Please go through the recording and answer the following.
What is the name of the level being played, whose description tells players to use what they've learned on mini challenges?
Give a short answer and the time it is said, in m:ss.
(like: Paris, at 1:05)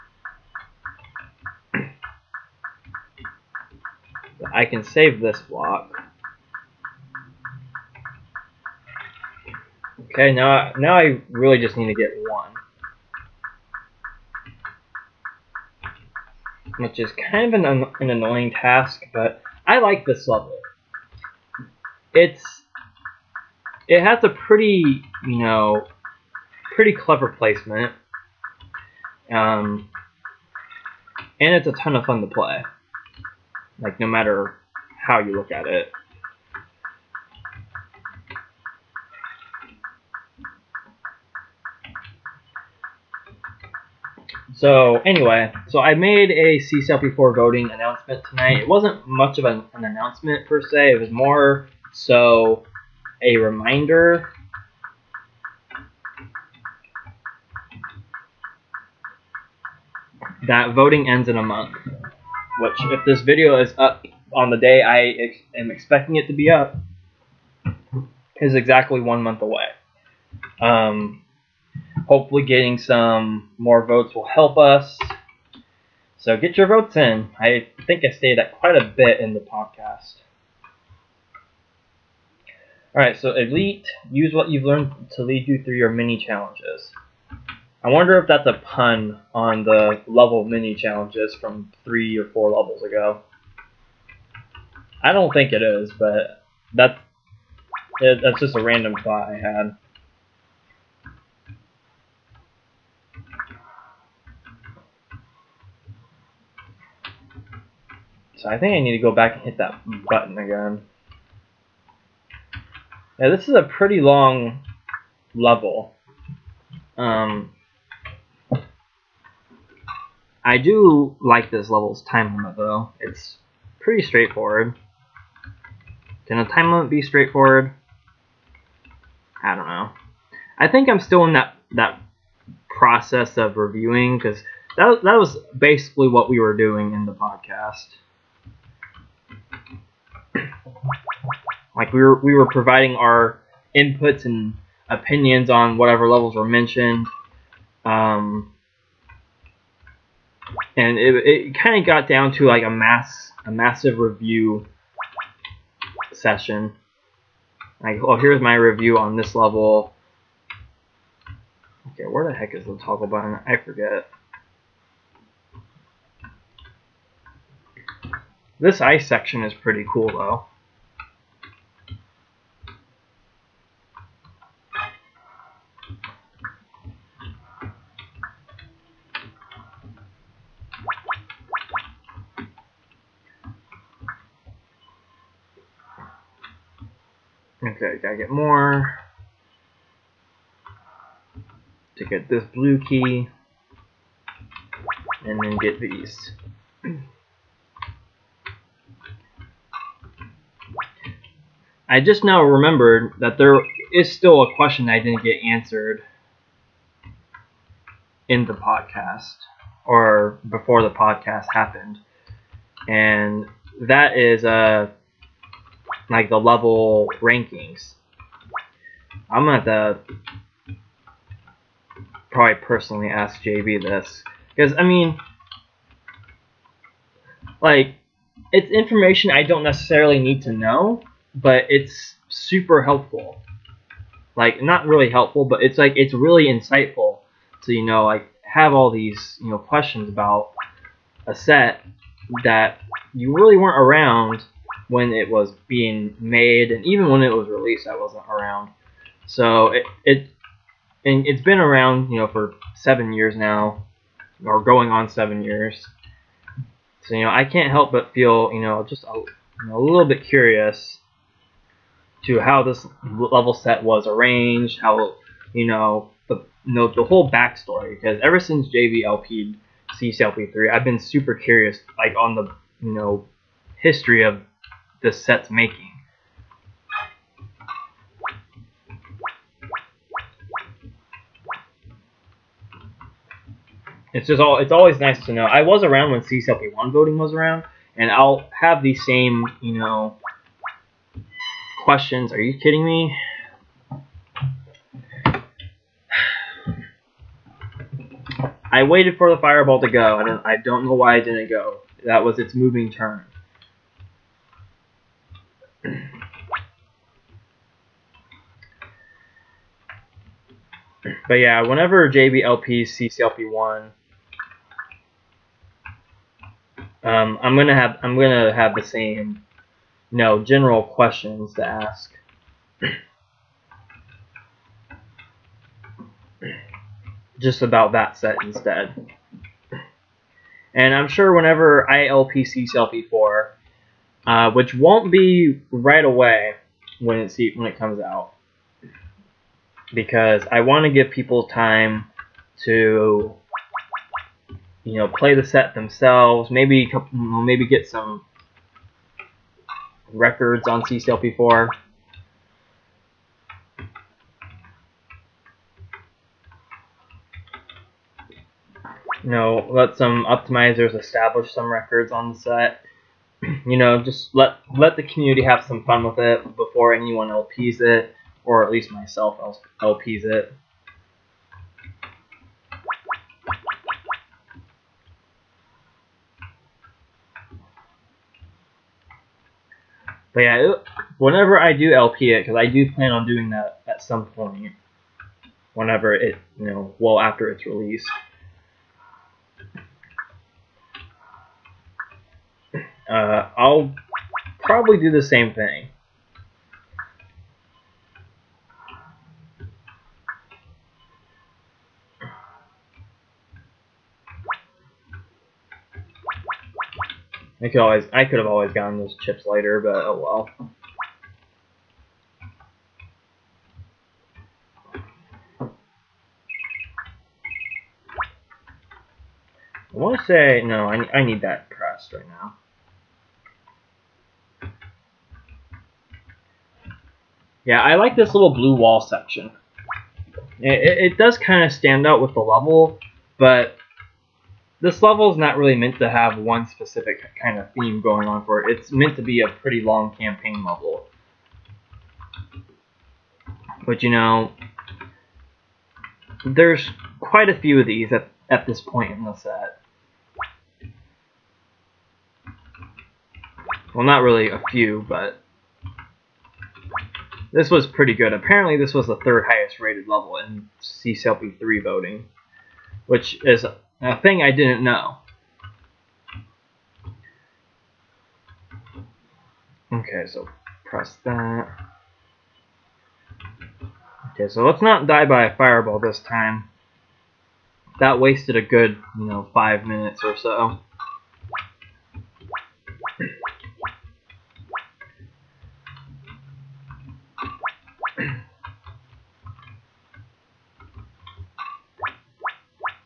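Elite, at 1:23.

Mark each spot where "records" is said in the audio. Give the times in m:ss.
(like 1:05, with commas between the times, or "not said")
5:50, 6:01.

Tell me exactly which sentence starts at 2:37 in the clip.
Like, oh, here's my review on this level.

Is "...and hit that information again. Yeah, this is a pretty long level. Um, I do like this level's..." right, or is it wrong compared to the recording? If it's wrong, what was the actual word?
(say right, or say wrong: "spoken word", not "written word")
wrong: "button", not "information".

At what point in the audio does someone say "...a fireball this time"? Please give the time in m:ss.
7:55.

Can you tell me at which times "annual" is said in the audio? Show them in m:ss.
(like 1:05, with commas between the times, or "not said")
not said.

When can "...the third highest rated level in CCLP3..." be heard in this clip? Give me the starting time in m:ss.
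7:39.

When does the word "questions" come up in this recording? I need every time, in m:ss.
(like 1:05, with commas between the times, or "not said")
3:24, 3:59, 4:51, 5:20.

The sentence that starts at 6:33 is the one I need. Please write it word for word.
Uh, I'll probably do the same thing.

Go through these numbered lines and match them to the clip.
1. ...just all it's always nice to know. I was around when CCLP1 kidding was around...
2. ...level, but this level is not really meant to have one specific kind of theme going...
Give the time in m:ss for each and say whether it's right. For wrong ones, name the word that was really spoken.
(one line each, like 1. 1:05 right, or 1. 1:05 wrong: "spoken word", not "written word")
1. 4:44 wrong: "voting", not "kidding"
2. 7:12 right.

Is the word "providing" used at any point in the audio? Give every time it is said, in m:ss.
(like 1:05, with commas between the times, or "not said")
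2:22.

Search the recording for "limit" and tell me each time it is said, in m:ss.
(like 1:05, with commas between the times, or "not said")
2:02, 2:06.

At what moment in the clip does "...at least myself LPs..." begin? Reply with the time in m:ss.
6:08.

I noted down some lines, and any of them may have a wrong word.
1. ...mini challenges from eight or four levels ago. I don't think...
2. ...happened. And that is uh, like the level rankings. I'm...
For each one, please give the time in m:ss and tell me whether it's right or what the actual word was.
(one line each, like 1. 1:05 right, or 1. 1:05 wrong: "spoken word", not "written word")
1. 1:30 wrong: "three", not "eight"
2. 3:31 right.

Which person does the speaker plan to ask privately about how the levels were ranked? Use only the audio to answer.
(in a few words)
JB.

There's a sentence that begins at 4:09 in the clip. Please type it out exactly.
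So it it and it's been around, you know, for seven years now, or going on seven years.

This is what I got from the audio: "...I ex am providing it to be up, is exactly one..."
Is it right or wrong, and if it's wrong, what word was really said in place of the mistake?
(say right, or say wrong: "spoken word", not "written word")
wrong: "expecting", not "providing".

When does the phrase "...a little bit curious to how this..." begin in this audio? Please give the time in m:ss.
4:19.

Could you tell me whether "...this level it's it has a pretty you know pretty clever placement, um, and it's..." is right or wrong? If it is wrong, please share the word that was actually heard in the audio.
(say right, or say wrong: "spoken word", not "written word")
right.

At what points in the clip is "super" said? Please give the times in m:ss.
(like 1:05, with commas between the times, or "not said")
3:52, 4:30.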